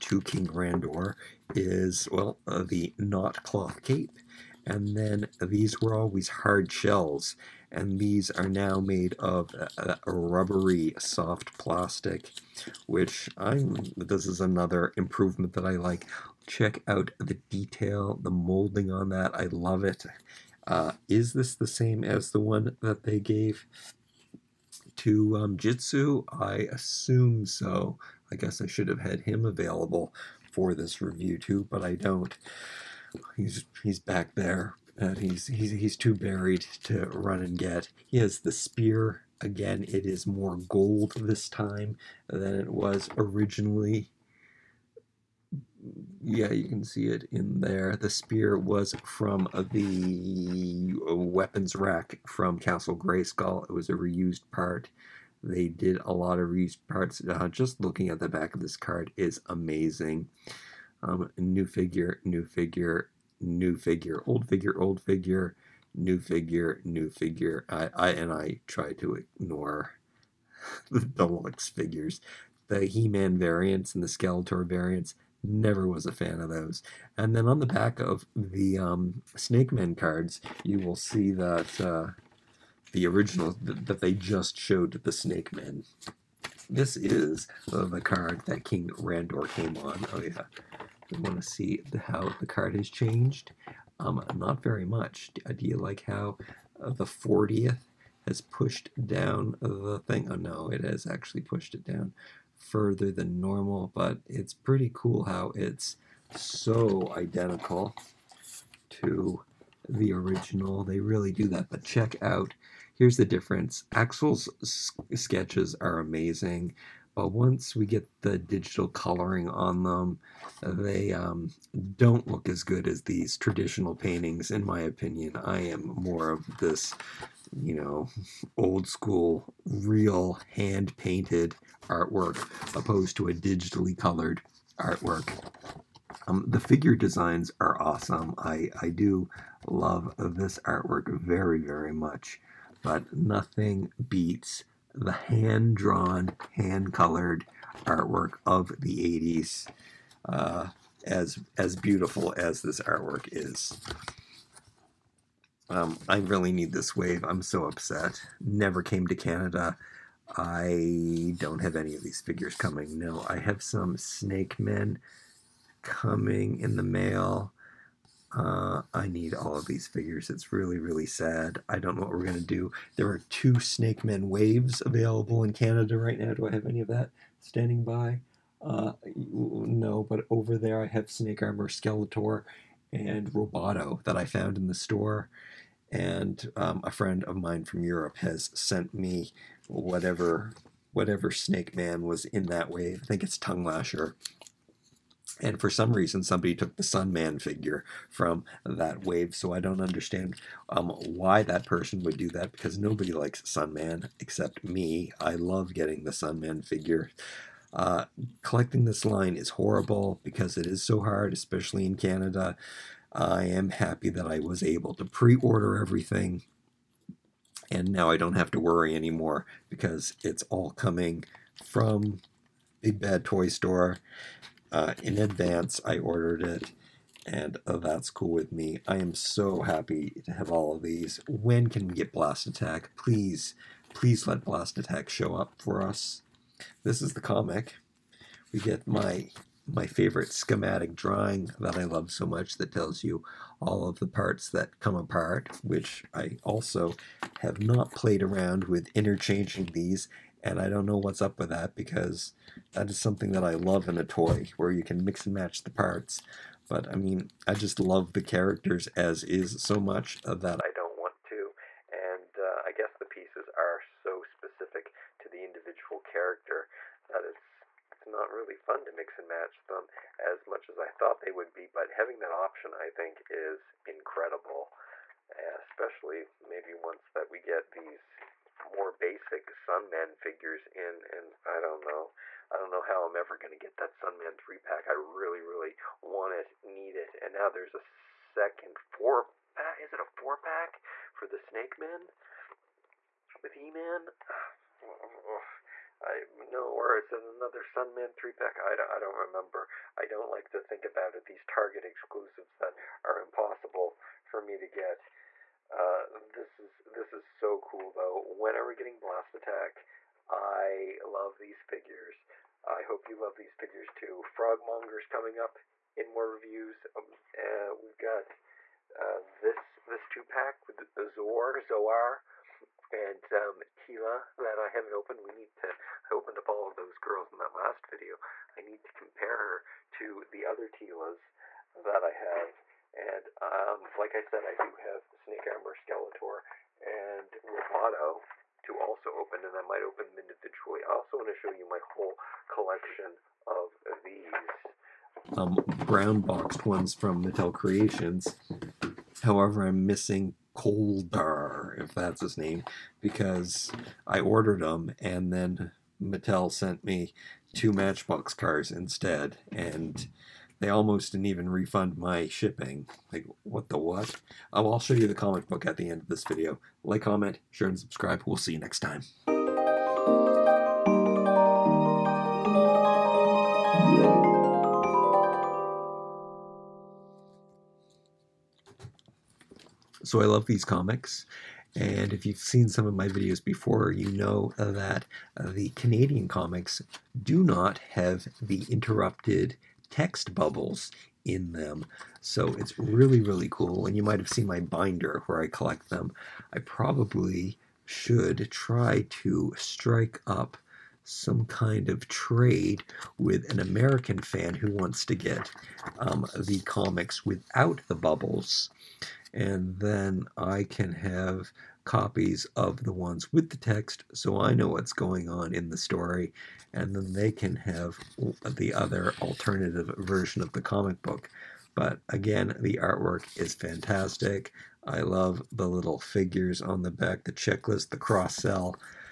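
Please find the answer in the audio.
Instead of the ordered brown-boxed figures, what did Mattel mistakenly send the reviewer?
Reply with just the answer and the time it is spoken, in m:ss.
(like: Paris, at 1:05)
Two Matchbox cars, at 5:57.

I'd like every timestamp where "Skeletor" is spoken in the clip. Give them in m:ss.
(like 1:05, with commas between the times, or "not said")
1:14, 3:01, 5:35.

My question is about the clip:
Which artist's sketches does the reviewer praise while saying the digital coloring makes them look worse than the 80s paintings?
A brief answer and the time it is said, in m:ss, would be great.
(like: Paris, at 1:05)
Axel, at 1:53.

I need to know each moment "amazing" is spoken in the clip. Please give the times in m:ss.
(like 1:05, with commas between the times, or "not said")
0:59, 1:55.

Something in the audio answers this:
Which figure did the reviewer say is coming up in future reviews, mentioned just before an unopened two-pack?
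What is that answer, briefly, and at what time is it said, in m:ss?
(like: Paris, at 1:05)
Frogmonger, at 5:14.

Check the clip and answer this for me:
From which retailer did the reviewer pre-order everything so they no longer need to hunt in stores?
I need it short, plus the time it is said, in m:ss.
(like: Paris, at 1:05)
Big Bad Toy Store, at 3:42.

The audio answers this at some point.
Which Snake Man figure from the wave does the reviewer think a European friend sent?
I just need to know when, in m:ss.
3:13.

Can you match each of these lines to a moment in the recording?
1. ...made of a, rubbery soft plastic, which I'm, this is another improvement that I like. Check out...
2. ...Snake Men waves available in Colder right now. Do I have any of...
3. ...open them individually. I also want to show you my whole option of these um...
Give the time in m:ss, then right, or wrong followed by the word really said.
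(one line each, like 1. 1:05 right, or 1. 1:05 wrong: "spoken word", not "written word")
1. 0:08 right
2. 2:53 wrong: "Canada", not "Colder"
3. 5:39 wrong: "collection", not "option".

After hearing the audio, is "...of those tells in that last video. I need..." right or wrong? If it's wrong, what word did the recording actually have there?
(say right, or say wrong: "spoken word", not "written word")
wrong: "girls", not "tells".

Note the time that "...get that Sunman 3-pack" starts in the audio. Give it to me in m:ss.
4:43.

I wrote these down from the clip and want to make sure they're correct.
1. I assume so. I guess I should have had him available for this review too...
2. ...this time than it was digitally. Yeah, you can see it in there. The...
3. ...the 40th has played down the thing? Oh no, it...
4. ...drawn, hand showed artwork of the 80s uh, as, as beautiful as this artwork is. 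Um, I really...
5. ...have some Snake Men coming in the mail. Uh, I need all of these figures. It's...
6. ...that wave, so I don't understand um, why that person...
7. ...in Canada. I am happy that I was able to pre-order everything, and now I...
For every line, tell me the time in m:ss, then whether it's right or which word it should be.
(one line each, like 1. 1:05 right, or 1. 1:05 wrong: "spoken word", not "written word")
1. 0:26 right
2. 0:41 wrong: "originally", not "digitally"
3. 1:36 wrong: "pushed", not "played"
4. 2:25 wrong: "colored", not "showed"
5. 2:43 right
6. 3:18 right
7. 3:31 right.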